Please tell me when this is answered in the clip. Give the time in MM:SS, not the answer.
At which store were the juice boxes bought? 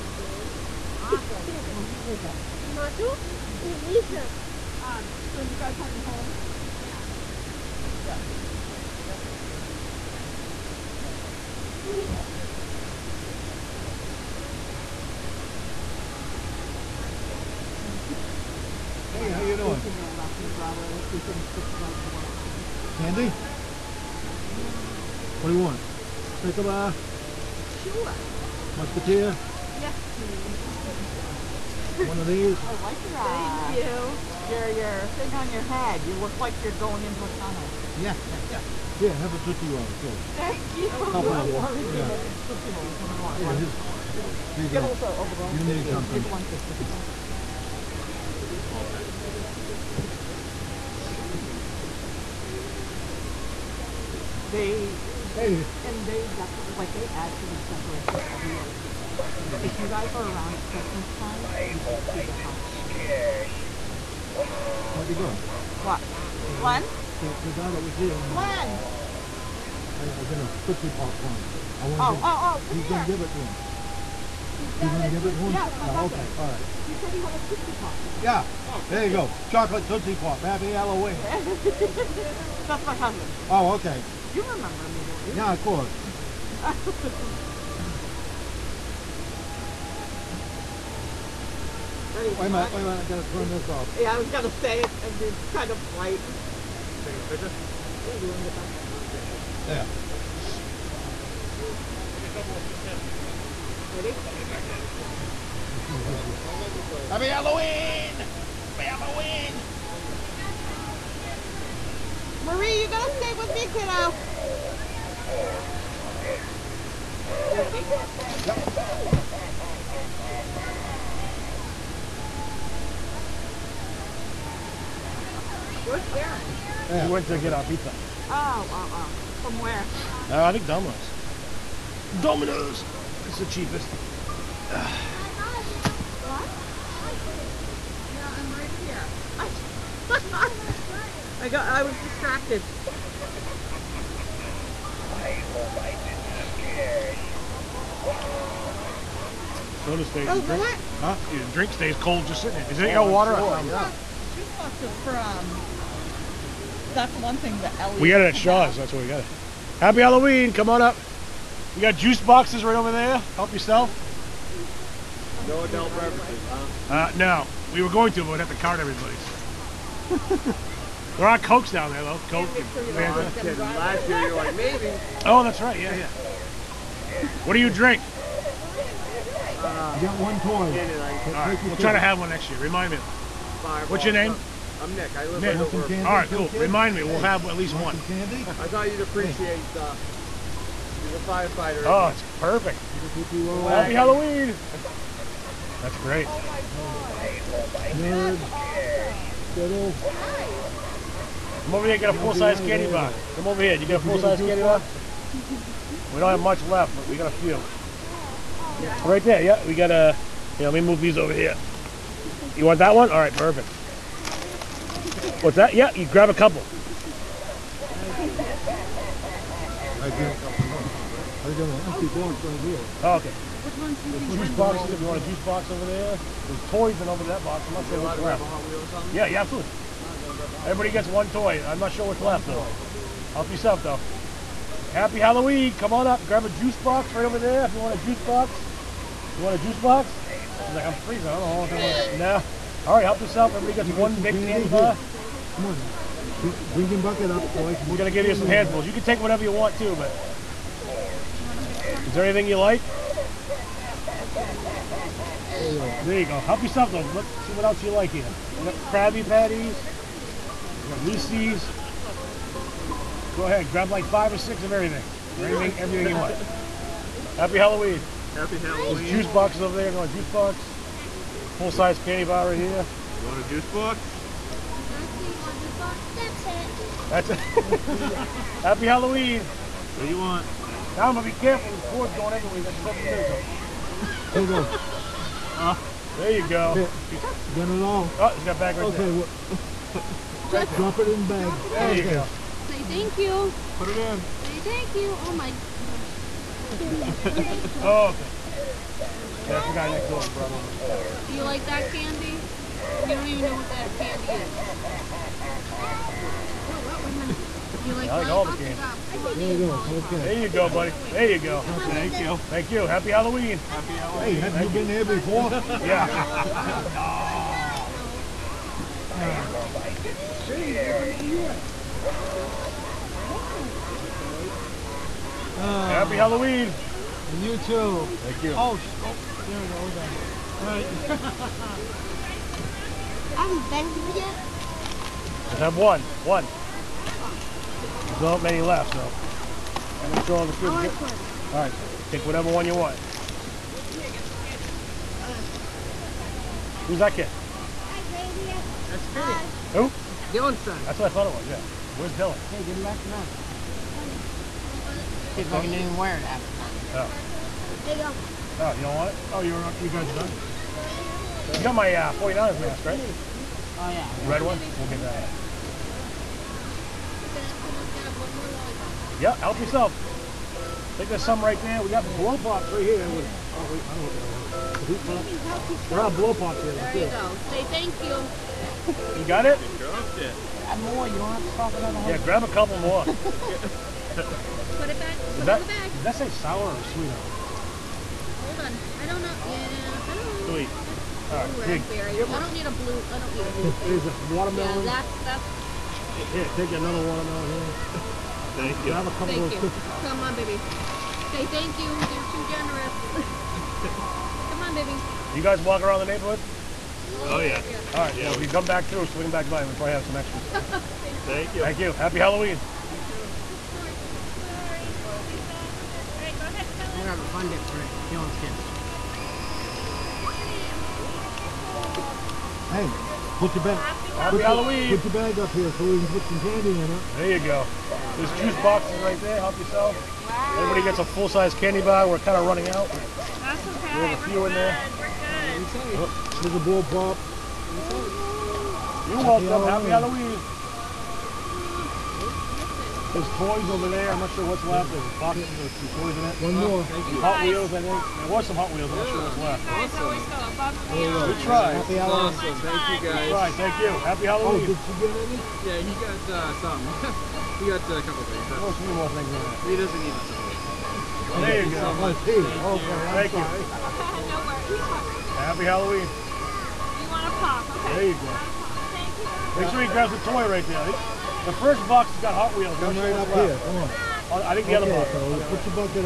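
02:38.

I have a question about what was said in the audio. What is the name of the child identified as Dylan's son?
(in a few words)
Finny.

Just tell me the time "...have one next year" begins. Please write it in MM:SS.
03:01.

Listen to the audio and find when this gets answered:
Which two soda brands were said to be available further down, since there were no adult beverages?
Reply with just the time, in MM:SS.
02:52.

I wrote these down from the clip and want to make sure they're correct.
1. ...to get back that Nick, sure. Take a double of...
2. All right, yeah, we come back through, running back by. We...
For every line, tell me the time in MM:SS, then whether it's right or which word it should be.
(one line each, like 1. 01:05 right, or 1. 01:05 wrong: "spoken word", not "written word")
1. 01:38 wrong: "Yeah", not "Nick"
2. 06:47 wrong: "swing", not "running".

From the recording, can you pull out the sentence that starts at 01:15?
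Yes, my no, Okay, all right.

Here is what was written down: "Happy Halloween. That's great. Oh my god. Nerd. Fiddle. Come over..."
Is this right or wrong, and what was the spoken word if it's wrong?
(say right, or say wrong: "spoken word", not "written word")
right.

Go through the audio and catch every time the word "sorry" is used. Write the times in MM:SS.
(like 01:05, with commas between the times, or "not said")
07:43.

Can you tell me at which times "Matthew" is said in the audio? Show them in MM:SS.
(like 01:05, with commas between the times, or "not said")
00:02.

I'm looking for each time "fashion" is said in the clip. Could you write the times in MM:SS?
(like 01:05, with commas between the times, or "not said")
not said.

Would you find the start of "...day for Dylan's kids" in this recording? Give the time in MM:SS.
06:57.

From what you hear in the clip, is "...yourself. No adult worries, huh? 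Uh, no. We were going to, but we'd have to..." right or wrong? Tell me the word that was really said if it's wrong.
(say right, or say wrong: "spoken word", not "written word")
wrong: "beverages", not "worries".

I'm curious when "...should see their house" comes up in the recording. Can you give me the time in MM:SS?
01:01.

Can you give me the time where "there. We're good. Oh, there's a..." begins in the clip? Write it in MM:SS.
07:14.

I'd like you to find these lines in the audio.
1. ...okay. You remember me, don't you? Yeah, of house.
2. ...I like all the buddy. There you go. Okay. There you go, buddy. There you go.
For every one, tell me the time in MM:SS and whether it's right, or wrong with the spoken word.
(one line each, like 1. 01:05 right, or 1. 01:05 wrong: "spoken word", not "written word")
1. 01:23 wrong: "course", not "house"
2. 05:08 wrong: "candy", not "buddy".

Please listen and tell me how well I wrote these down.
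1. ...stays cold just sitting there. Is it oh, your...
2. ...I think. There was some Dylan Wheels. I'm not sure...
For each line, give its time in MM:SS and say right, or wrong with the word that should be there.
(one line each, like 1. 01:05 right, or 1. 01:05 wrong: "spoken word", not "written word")
1. 02:31 right
2. 07:27 wrong: "Hot", not "Dylan".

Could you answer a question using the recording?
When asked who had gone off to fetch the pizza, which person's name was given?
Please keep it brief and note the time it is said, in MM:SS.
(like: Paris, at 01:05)
Darren, at 02:06.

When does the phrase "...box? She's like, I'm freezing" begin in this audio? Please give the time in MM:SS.
03:59.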